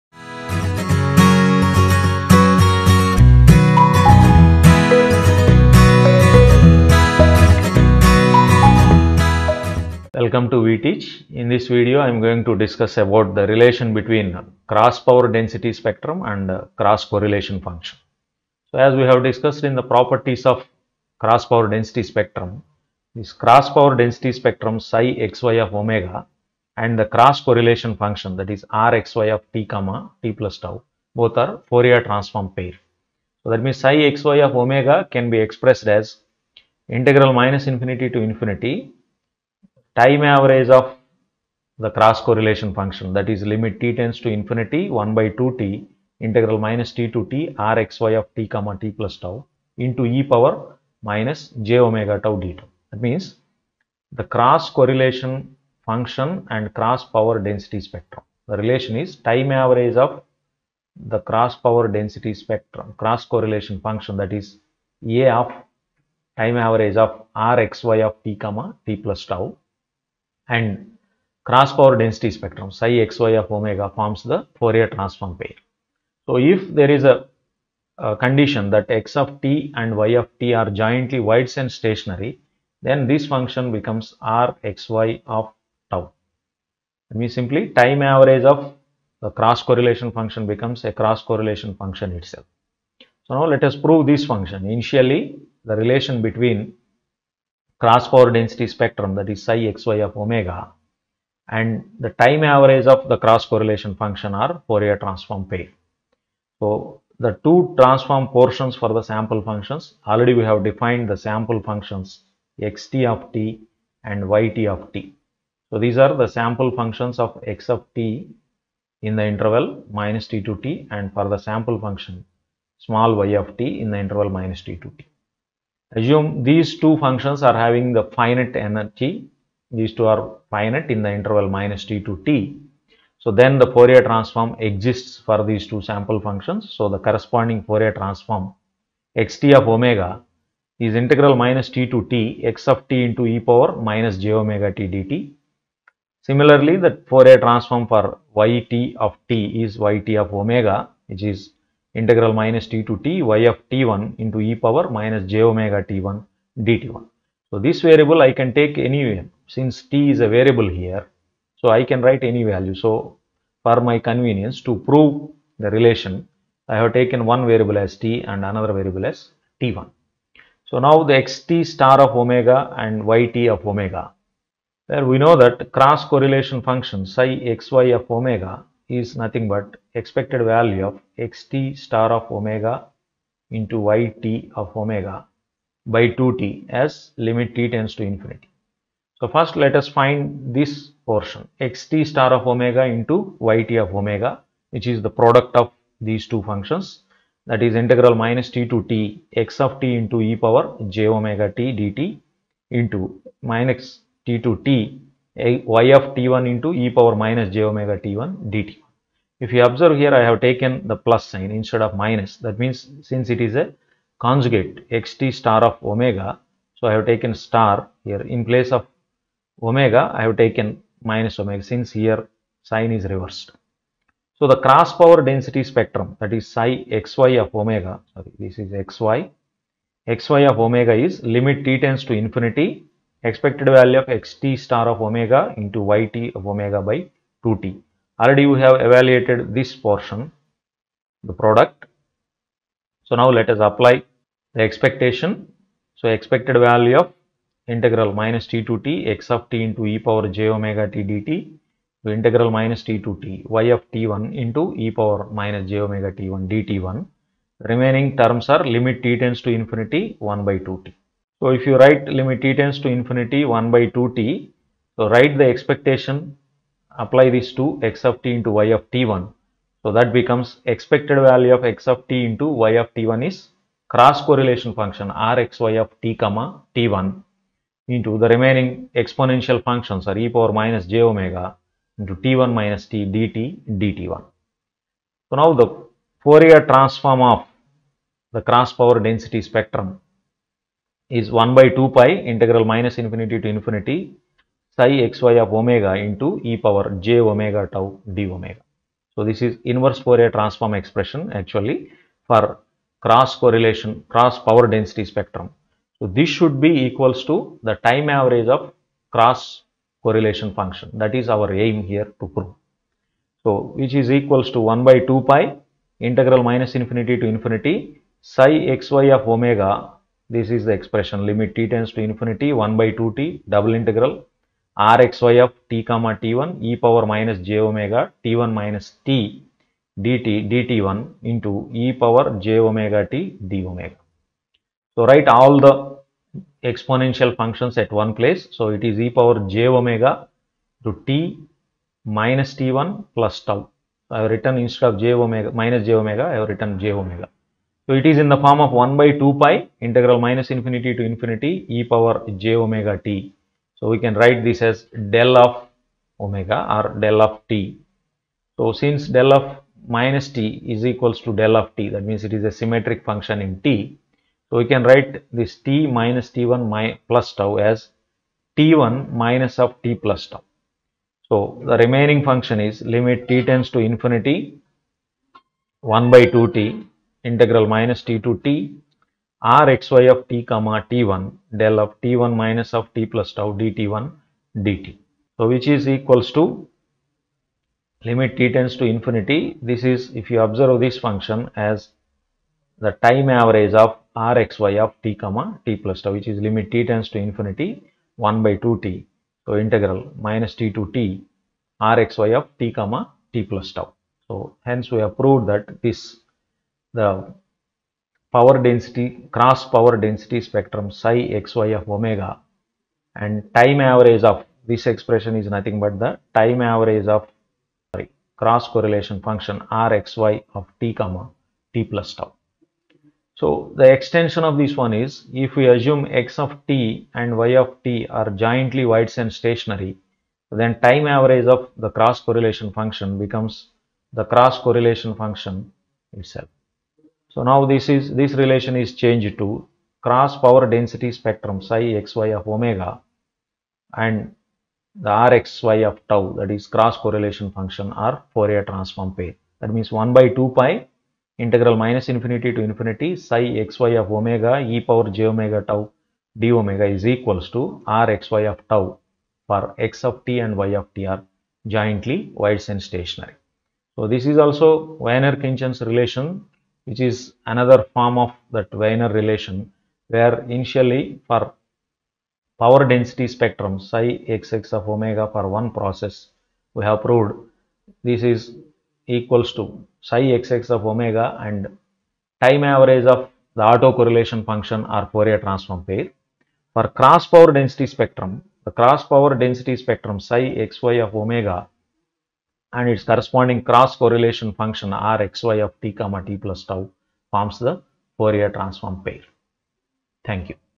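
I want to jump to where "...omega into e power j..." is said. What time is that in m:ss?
4:55.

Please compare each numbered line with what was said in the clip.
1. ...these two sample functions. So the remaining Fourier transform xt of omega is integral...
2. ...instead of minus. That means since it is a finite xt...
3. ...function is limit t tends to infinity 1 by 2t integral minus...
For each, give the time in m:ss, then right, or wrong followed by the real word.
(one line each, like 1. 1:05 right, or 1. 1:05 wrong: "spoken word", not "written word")
1. 2:15 wrong: "corresponding", not "remaining"
2. 3:31 wrong: "conjugate", not "finite"
3. 6:12 right.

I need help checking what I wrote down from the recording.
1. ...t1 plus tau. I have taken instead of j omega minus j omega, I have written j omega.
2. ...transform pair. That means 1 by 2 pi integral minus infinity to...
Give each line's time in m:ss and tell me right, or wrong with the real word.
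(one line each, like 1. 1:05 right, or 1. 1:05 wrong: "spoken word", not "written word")
1. 5:42 wrong: "written", not "taken"
2. 7:28 right.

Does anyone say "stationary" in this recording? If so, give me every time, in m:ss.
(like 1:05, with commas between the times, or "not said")
1:21, 7:09, 7:42.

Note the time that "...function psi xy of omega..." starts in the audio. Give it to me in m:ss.
2:56.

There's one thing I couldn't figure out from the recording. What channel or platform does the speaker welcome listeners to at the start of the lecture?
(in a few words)
VeTeach.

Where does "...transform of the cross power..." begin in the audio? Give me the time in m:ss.
4:46.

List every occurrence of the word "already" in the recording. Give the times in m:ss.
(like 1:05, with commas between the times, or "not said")
1:50, 3:58.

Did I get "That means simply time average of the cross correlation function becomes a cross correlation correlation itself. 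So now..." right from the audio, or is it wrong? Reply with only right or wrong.
wrong.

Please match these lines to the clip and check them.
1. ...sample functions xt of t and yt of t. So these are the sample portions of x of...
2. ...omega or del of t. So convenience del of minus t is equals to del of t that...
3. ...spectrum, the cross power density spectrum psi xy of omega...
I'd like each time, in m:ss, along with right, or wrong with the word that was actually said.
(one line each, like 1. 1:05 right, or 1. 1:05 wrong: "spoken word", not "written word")
1. 1:51 wrong: "functions", not "portions"
2. 5:56 wrong: "since", not "convenience"
3. 8:07 right.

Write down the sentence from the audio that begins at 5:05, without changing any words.
So, this should be equals to the time average of cross correlation function that is our aim here to prove.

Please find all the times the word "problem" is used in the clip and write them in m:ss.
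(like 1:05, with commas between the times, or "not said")
not said.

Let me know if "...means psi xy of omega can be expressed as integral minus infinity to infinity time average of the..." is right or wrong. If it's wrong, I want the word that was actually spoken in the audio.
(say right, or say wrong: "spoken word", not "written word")
right.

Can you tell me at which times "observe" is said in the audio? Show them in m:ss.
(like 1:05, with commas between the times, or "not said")
3:29, 6:30.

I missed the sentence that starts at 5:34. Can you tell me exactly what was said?
So write all the exponential functions at one place.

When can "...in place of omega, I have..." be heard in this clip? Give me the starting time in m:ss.
3:38.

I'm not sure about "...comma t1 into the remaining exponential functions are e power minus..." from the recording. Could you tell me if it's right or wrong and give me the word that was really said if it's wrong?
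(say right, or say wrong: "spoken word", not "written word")
right.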